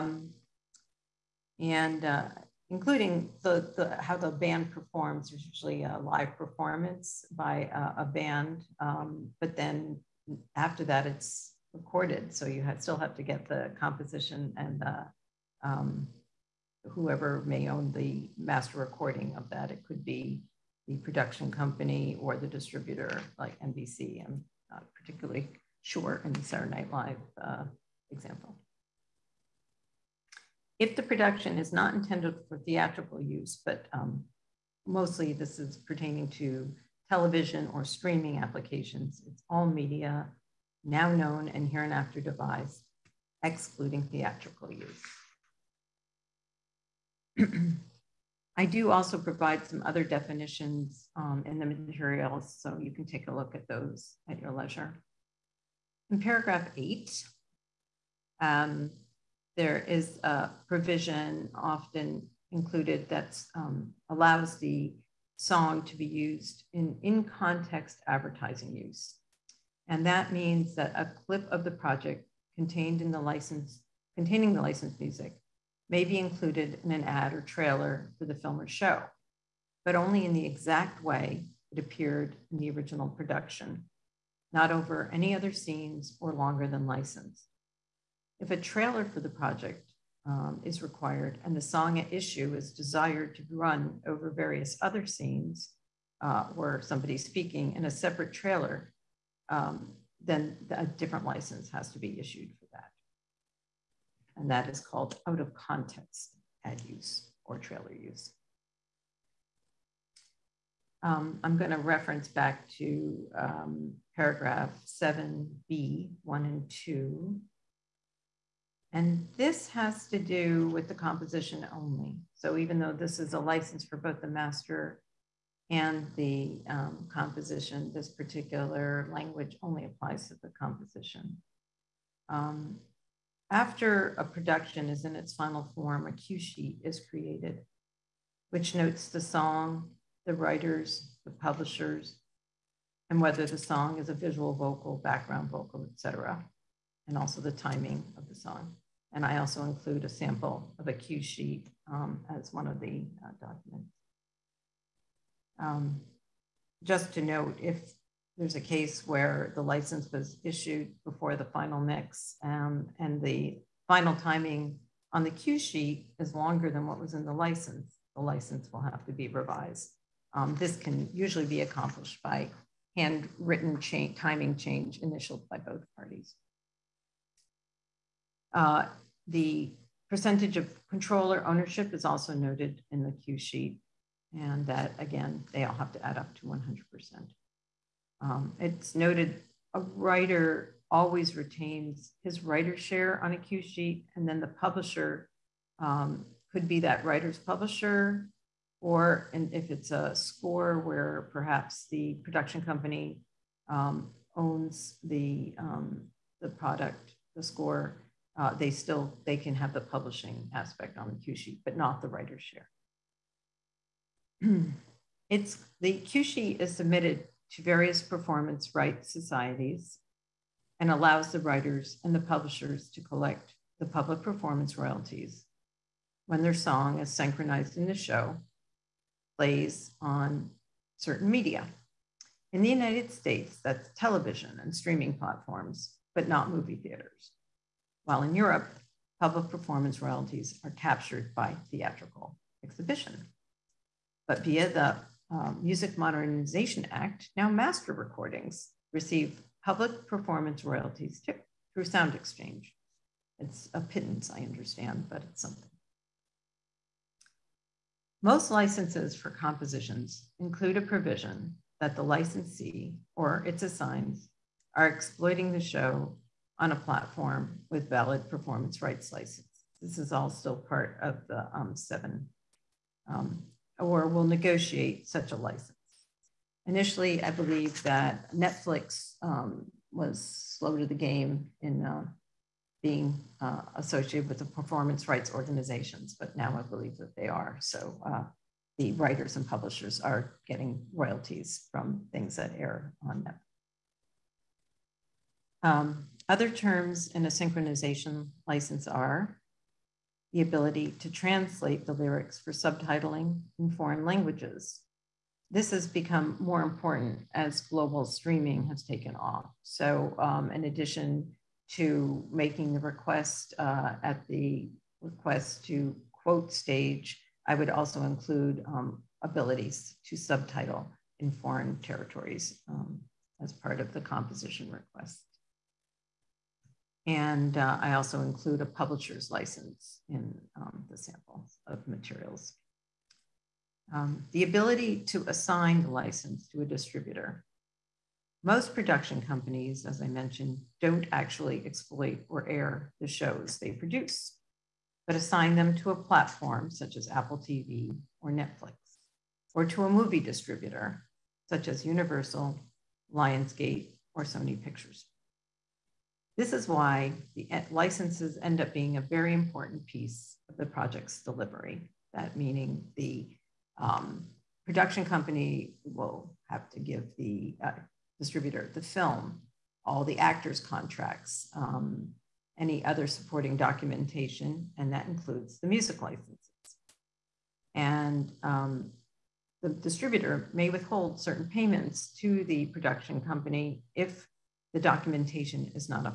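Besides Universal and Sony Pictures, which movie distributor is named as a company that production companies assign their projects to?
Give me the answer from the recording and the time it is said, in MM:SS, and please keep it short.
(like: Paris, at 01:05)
Lionsgate, at 05:53.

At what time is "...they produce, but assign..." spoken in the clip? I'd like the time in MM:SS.
05:43.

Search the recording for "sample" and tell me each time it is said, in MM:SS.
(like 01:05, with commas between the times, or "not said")
02:30, 05:30.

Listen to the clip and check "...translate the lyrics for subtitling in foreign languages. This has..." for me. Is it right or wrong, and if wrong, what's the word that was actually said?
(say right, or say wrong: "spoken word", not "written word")
right.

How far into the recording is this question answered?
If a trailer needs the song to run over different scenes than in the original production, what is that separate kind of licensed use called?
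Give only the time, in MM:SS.
01:45.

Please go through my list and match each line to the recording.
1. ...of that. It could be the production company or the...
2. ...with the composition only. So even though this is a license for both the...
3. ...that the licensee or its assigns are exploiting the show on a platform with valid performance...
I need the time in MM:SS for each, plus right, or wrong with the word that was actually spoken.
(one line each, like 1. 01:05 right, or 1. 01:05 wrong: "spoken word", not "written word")
1. 00:19 right
2. 02:00 right
3. 04:21 right.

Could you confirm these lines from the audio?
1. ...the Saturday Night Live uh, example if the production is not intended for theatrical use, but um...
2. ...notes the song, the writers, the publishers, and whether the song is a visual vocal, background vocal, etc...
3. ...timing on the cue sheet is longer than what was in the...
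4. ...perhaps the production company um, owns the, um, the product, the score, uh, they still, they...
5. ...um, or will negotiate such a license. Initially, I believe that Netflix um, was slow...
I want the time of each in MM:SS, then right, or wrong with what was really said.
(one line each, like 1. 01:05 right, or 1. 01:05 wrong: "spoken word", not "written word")
1. 00:26 right
2. 02:18 right
3. 02:44 right
4. 03:21 right
5. 04:33 right.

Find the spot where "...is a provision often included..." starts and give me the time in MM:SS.
00:59.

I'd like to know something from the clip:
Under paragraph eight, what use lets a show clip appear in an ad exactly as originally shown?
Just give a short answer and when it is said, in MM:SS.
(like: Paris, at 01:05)
In context advertising use, at 01:07.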